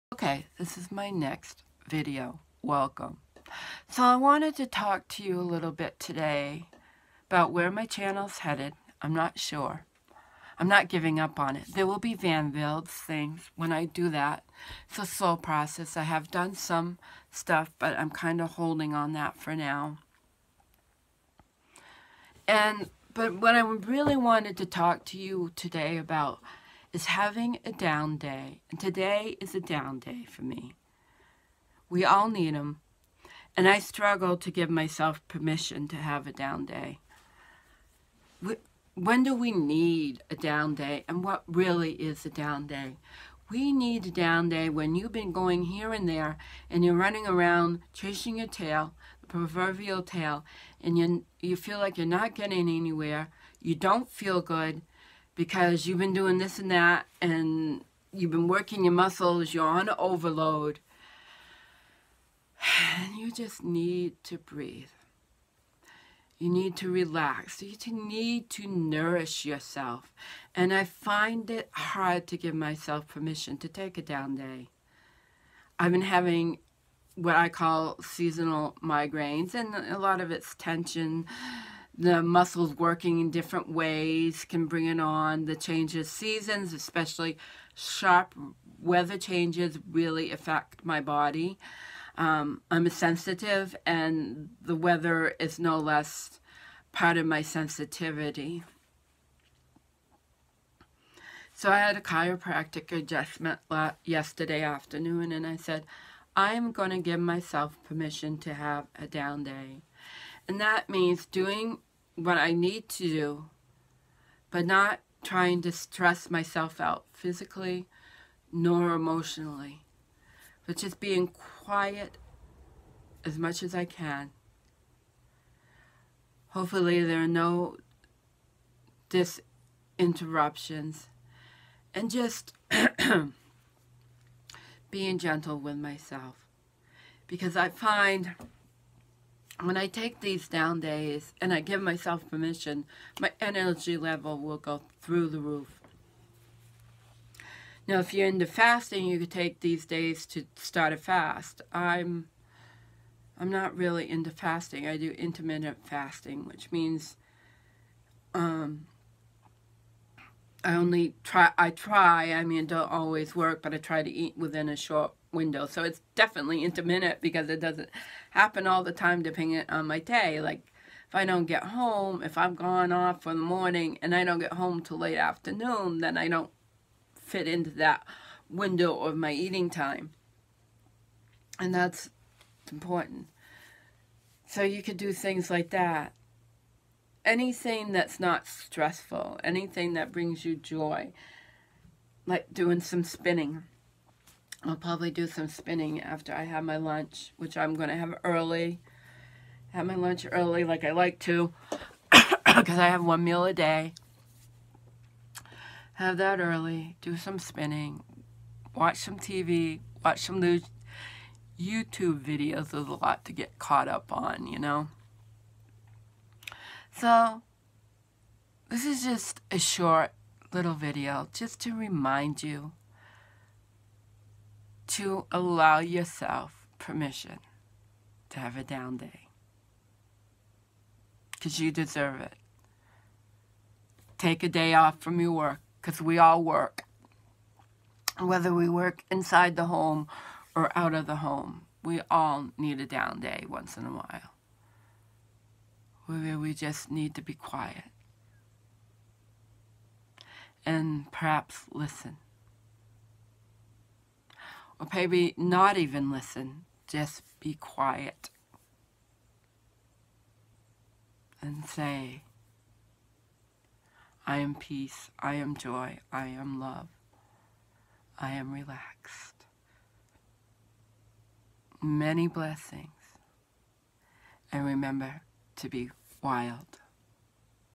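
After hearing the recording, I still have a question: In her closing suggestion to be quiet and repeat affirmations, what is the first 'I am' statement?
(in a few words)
peace.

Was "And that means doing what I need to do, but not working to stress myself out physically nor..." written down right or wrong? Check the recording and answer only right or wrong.
wrong.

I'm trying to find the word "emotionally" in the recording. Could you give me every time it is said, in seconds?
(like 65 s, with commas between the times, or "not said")
118 s.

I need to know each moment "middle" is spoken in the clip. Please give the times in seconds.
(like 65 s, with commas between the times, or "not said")
not said.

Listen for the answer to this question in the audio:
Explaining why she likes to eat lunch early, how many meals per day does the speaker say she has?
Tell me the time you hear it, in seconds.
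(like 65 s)
203 s.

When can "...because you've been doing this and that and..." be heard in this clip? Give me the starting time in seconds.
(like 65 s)
55 s.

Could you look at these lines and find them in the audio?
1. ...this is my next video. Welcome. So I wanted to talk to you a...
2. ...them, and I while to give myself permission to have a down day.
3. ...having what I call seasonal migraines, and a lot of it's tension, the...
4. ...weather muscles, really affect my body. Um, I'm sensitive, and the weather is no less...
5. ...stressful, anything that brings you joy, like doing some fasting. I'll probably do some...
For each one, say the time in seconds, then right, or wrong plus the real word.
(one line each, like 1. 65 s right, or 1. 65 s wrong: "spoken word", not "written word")
1. 0 s right
2. 32 s wrong: "struggle", not "while"
3. 76 s right
4. 88 s wrong: "changes", not "muscles"
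5. 188 s wrong: "spinning", not "fasting".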